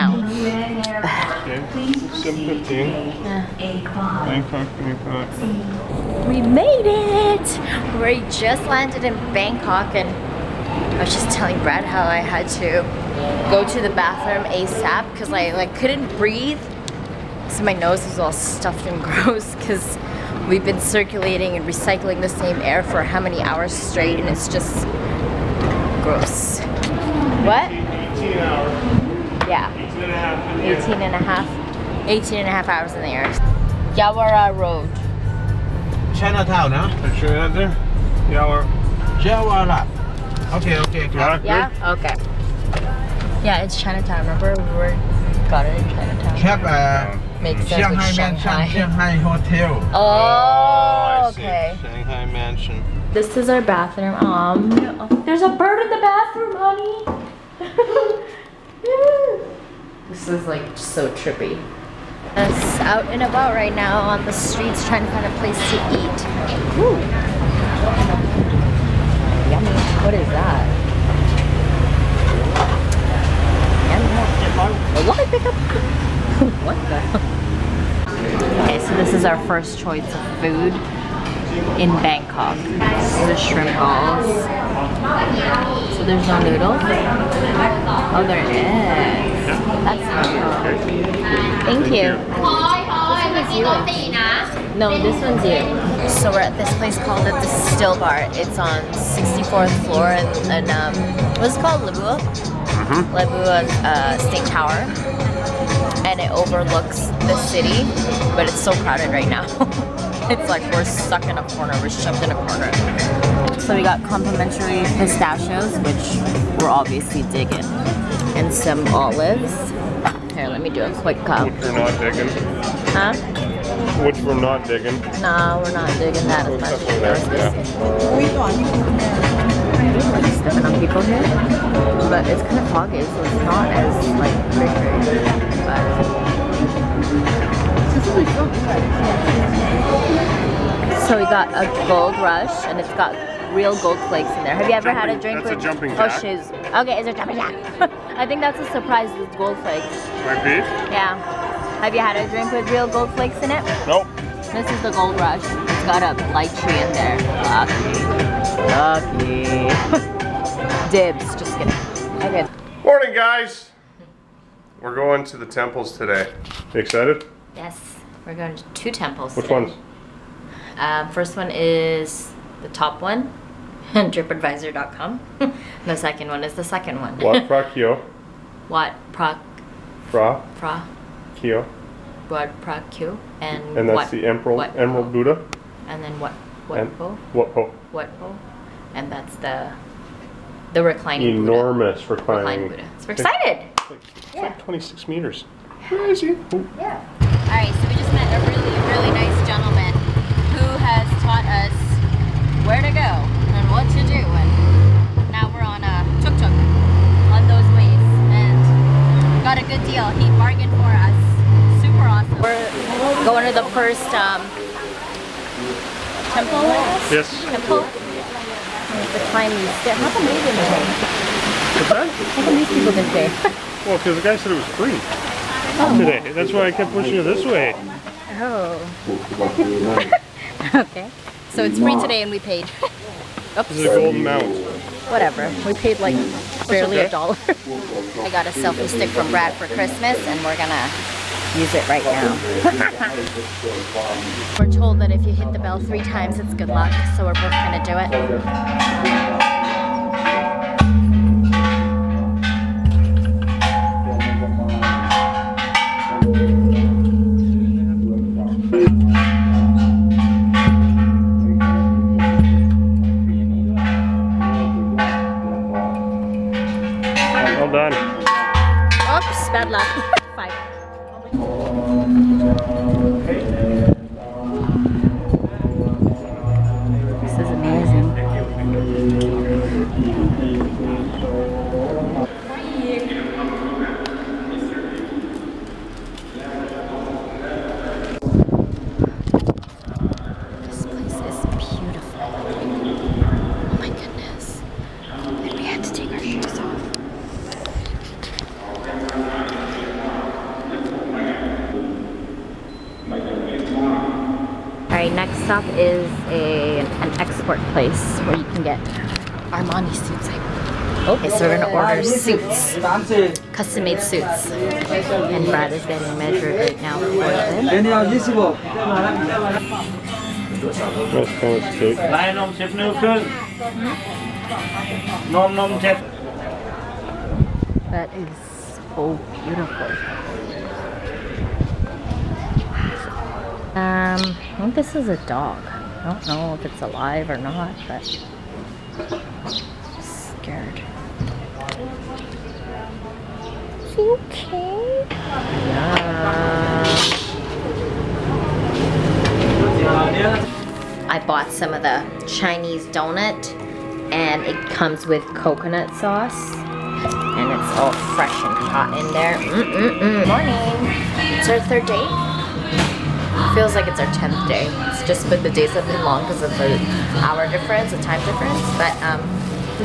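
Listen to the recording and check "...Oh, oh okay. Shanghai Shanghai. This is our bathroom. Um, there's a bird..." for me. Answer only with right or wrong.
wrong.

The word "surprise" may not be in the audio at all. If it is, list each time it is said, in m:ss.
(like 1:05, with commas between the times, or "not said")
2:28.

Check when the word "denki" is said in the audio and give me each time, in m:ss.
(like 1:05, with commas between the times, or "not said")
not said.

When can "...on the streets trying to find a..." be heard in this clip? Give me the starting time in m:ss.
1:04.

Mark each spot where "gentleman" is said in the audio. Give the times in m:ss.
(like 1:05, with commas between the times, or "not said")
3:19.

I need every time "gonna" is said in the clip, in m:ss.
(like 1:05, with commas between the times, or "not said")
4:00, 4:07.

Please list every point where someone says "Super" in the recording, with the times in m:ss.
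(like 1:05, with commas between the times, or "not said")
3:31.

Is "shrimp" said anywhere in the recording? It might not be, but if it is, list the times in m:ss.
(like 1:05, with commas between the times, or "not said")
1:23.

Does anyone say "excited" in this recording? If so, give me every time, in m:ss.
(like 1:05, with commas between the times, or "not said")
2:46, 3:13.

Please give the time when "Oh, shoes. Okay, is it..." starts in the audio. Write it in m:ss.
2:26.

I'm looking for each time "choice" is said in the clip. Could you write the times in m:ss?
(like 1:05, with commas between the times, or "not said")
1:19.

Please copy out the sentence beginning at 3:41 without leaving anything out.
How come these people didn't pay?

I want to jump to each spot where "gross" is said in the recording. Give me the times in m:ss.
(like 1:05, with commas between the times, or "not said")
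0:19, 0:26.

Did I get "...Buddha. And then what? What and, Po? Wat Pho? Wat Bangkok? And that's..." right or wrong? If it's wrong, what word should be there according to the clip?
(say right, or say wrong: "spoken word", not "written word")
wrong: "Pho", not "Bangkok".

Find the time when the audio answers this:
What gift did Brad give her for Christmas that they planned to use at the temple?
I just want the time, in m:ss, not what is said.
3:58.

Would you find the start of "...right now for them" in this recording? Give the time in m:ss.
5:16.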